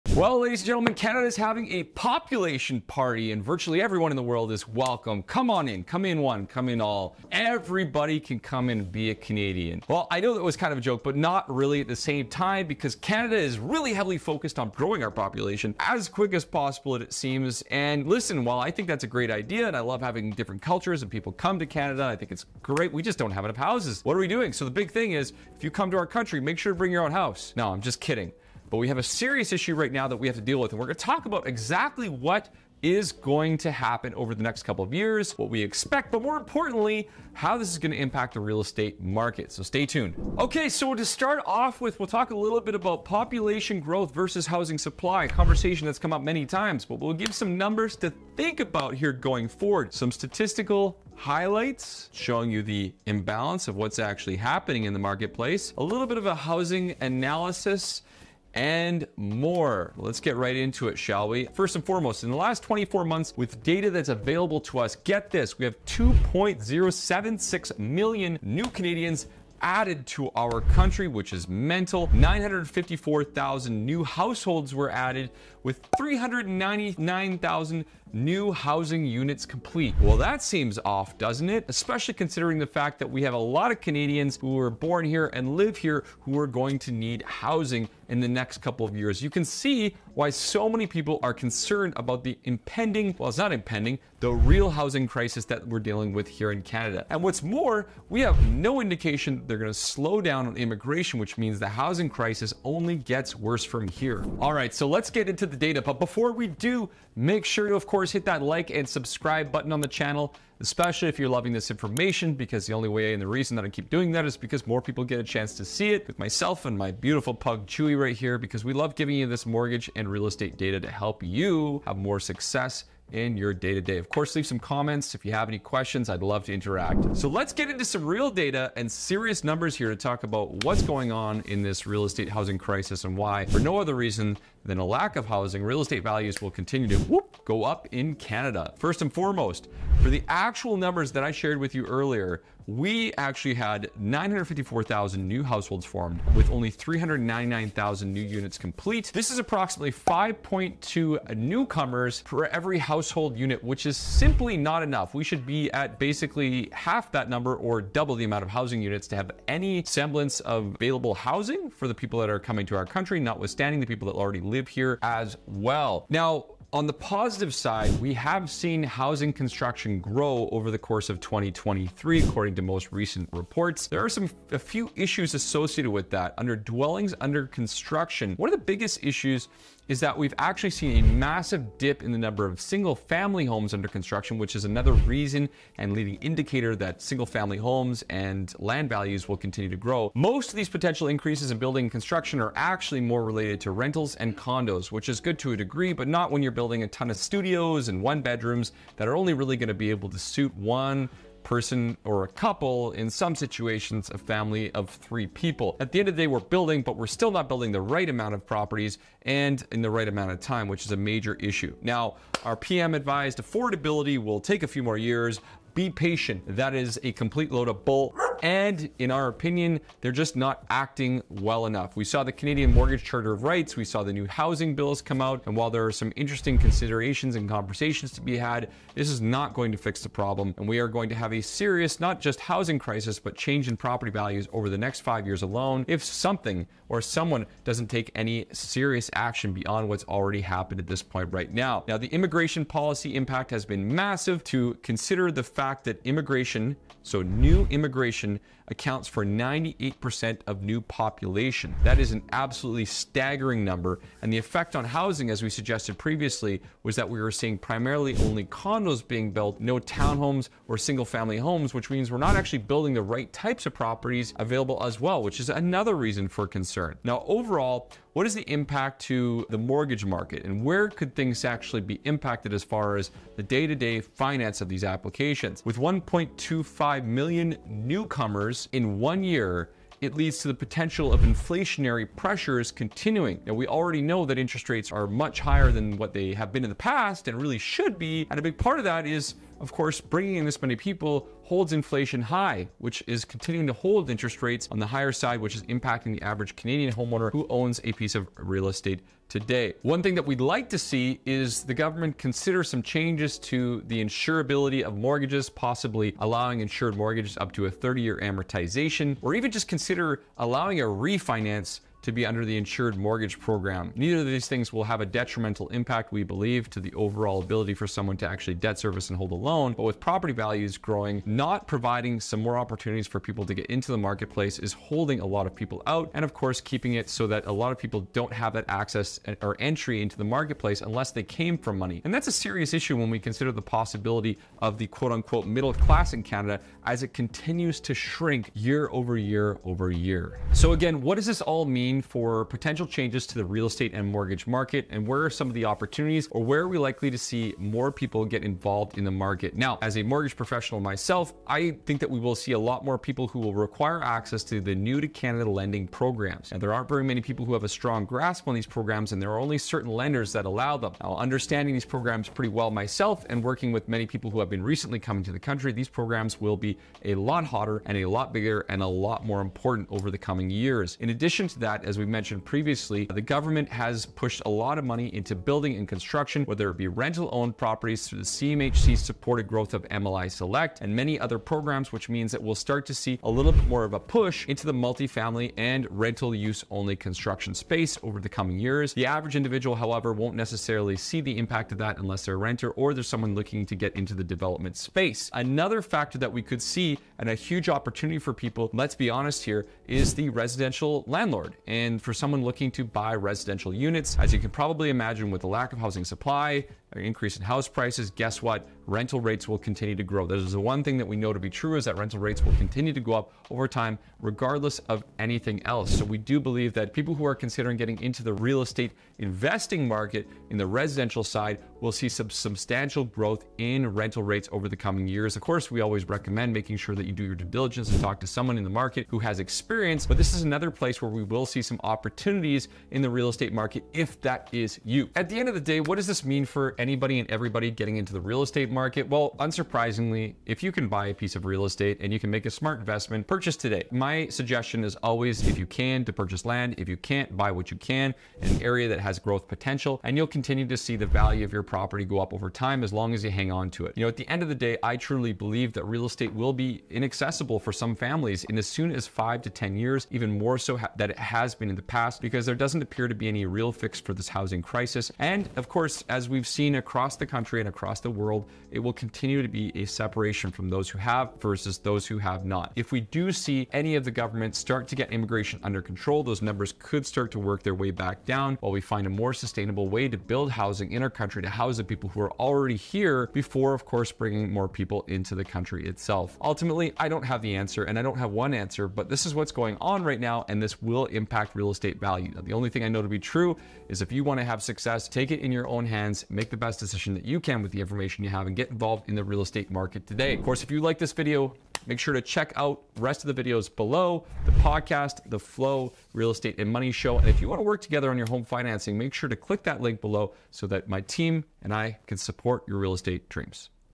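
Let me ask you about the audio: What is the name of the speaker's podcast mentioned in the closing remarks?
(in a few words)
The Flow Real Estate and Money Show.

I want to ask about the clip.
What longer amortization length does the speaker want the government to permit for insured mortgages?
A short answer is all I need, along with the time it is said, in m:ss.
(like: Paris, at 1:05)
30 years, at 5:07.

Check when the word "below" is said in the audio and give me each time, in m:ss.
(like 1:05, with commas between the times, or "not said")
8:23, 8:29.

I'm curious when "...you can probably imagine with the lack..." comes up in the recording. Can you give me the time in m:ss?
6:44.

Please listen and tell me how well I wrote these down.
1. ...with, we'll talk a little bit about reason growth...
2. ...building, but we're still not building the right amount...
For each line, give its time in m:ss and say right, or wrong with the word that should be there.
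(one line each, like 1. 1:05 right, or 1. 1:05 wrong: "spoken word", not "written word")
1. 0:41 wrong: "population", not "reason"
2. 3:26 right.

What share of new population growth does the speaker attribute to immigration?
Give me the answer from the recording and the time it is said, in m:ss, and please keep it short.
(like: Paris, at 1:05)
98%, at 4:09.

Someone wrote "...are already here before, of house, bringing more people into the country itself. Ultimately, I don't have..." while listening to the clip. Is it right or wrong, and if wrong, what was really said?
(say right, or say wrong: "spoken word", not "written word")
wrong: "course", not "house".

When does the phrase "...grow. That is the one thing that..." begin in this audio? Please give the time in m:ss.
6:50.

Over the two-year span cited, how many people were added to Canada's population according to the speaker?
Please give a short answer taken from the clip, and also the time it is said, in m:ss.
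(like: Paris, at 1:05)
2.076 million, at 1:05.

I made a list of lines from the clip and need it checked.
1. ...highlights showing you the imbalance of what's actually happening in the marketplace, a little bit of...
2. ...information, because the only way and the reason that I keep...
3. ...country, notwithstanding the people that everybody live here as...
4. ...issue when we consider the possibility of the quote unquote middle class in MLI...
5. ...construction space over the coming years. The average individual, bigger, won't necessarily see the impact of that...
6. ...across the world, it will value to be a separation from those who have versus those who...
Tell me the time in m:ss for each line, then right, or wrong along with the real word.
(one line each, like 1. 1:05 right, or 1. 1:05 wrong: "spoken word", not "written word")
1. 0:51 right
2. 1:51 right
3. 2:42 wrong: "already", not "everybody"
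4. 5:32 wrong: "Canada", not "MLI"
5. 6:26 wrong: "however", not "bigger"
6. 7:47 wrong: "continue", not "value".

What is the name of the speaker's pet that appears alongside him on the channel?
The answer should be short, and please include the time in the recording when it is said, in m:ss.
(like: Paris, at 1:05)
Chewy, at 1:57.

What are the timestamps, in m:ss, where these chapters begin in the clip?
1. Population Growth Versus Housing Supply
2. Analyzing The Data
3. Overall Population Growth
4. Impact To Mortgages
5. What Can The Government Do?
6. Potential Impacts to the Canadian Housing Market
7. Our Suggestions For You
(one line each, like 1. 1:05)
1. 0:40
2. 2:07
3. 4:02
4. 4:26
5. 5:00
6. 5:40
7. 7:16.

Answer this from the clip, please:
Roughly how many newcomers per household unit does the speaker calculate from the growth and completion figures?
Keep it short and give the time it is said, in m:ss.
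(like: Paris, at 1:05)
5.2, at 2:29.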